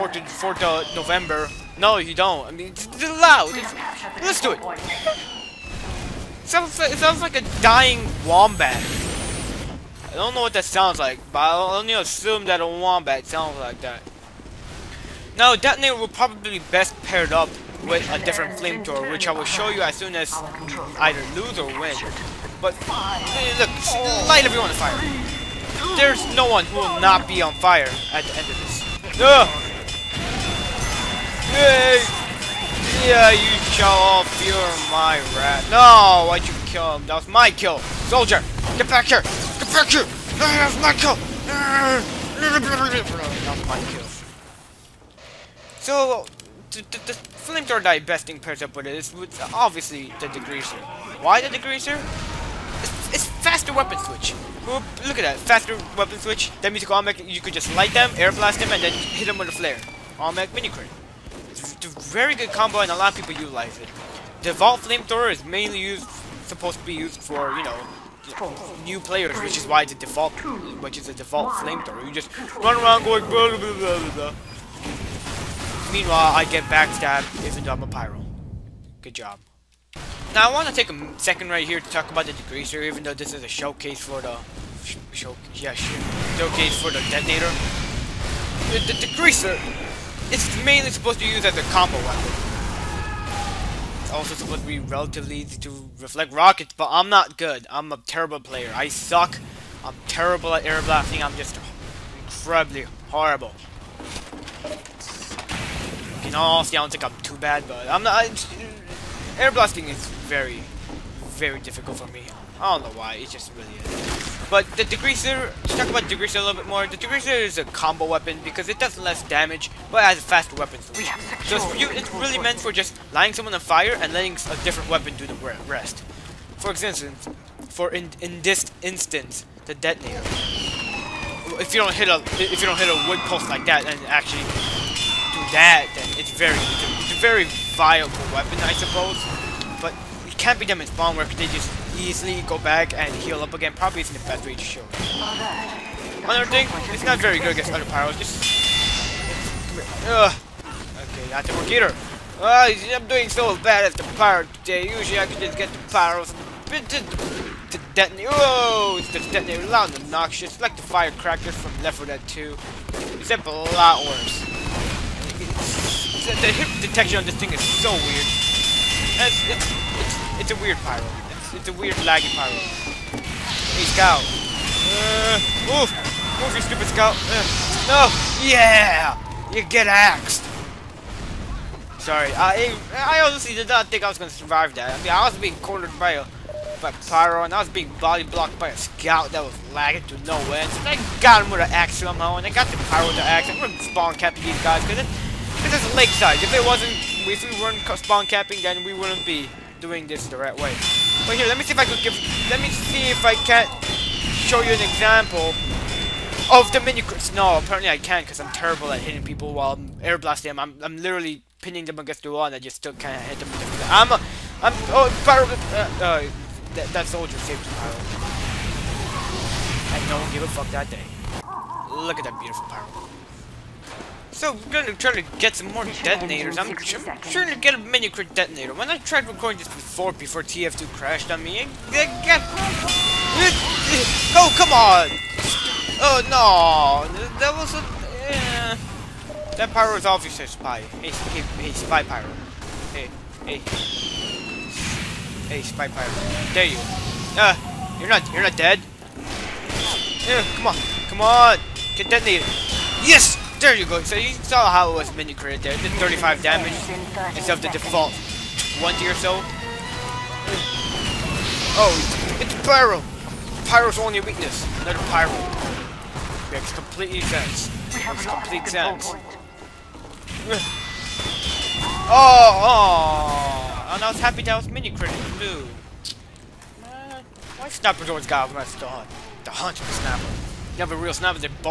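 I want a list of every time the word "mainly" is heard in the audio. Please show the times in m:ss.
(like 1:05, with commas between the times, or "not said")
1:05, 1:30.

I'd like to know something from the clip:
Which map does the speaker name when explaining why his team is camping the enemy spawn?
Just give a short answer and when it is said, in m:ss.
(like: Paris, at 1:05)
Lakeside, at 3:15.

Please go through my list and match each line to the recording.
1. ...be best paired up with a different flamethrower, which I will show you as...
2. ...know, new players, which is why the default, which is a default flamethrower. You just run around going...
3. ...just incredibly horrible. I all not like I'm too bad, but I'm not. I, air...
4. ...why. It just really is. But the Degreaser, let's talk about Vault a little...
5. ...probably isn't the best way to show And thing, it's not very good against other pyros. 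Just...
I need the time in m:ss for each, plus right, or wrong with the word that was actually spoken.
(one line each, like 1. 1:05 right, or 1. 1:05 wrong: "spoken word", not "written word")
1. 0:16 right
2. 1:07 right
3. 1:41 right
4. 1:52 wrong: "Degreaser", not "Vault"
5. 2:23 wrong: "Another", not "And".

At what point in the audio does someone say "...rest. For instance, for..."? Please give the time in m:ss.
2:05.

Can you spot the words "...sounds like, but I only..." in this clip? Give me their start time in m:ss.
0:10.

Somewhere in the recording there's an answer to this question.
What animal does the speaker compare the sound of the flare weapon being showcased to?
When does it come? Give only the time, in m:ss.
0:07.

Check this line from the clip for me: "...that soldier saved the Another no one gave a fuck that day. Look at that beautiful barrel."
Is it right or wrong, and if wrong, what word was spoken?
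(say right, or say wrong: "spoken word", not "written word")
wrong: "And", not "Another".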